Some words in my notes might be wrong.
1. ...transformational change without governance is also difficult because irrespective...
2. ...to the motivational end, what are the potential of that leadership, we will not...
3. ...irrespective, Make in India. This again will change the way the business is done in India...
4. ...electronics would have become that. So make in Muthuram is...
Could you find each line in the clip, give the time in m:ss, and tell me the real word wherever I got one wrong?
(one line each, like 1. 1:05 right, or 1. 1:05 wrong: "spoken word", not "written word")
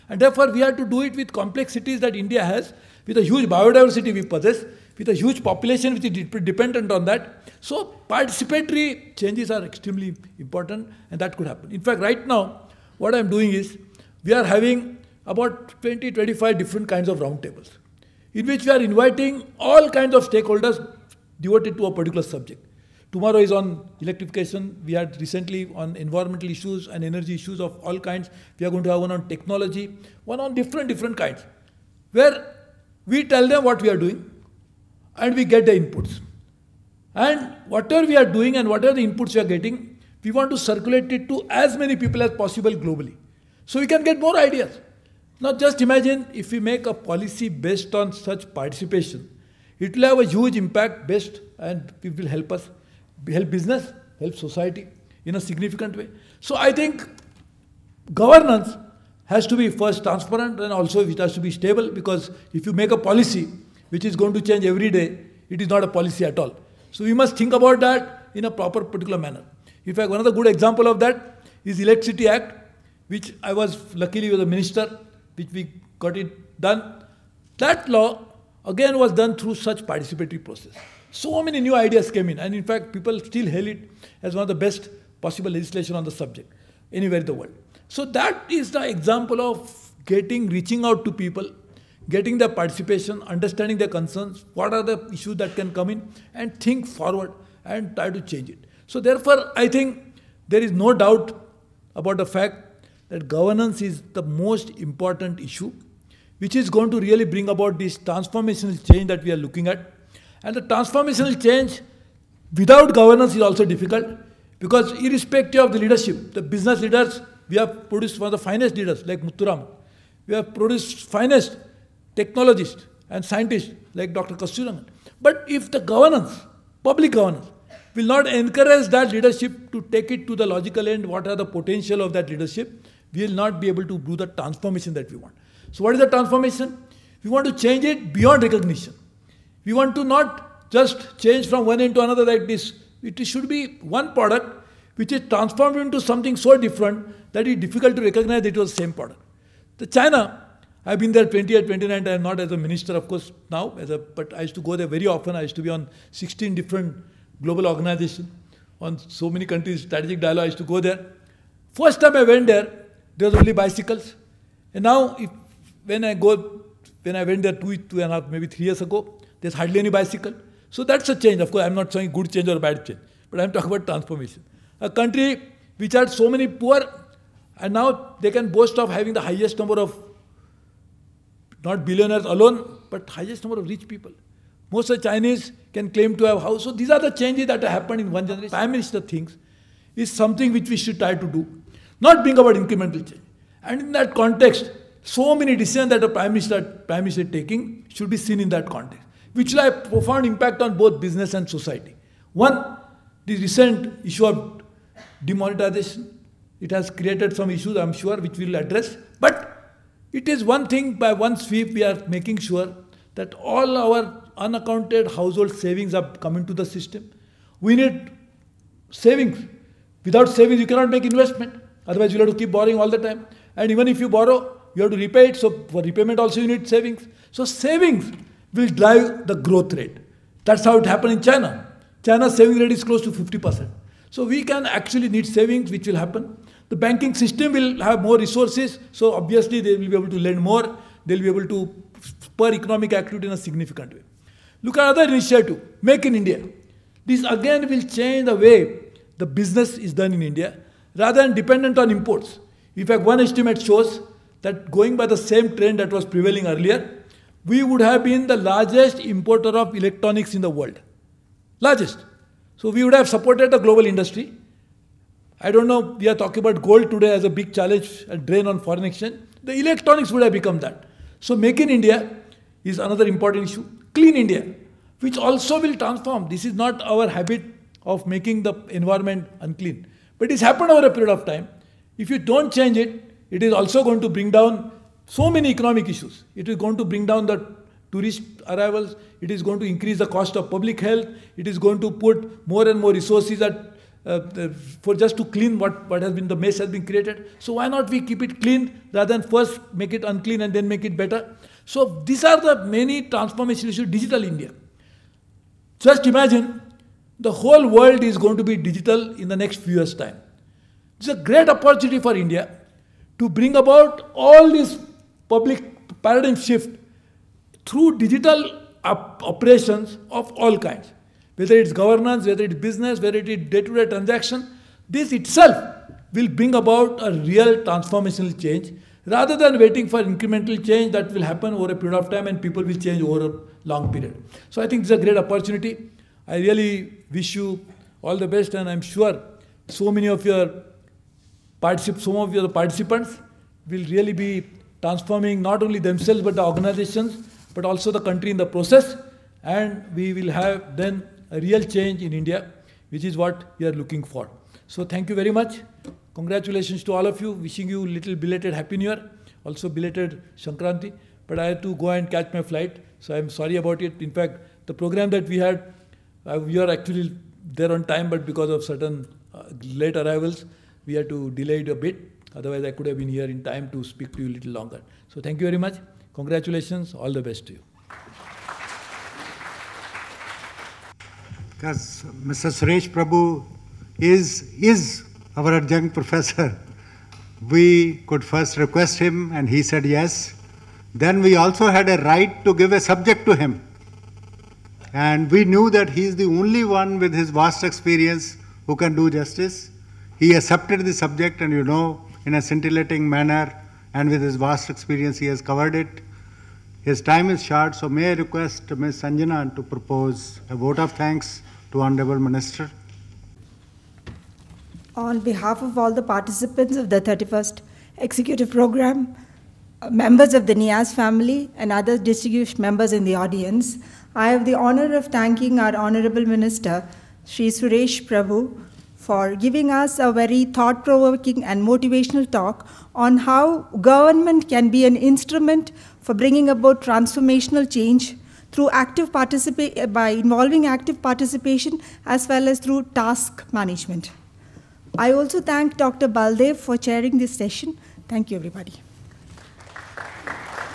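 1. 1:50 right
2. 2:10 wrong: "logical", not "motivational"
3. 4:05 wrong: "initiative", not "irrespective"
4. 4:29 wrong: "India", not "Muthuram".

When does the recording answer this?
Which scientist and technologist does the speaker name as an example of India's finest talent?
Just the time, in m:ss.
2:04.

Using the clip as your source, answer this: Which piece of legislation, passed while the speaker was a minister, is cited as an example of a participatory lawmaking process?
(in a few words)
Electricity Act.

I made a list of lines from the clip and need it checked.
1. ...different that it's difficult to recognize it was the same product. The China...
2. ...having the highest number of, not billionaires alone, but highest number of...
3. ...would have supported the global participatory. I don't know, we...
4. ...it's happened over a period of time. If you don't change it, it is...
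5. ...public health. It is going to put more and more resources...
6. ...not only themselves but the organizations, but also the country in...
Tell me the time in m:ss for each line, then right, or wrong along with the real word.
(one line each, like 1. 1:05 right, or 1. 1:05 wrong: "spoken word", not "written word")
1. 2:26 right
2. 2:58 right
3. 4:22 wrong: "industry", not "participatory"
4. 4:40 right
5. 4:50 right
6. 5:45 right.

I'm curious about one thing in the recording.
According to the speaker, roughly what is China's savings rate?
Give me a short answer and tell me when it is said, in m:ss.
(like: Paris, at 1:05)
Close to 50%, at 3:52.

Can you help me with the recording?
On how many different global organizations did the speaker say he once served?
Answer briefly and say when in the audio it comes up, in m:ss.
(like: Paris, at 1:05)
16, at 2:36.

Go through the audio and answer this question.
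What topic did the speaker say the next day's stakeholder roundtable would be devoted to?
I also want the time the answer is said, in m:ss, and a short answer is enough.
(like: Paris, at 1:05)
Electrification, at 0:24.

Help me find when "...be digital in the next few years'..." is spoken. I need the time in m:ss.
5:08.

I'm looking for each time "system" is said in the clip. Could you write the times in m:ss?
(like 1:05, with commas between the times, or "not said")
3:36, 3:57.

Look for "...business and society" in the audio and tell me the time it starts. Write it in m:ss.
3:21.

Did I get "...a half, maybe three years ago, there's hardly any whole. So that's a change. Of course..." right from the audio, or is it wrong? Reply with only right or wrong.
wrong.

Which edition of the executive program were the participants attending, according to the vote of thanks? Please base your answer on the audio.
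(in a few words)
31st.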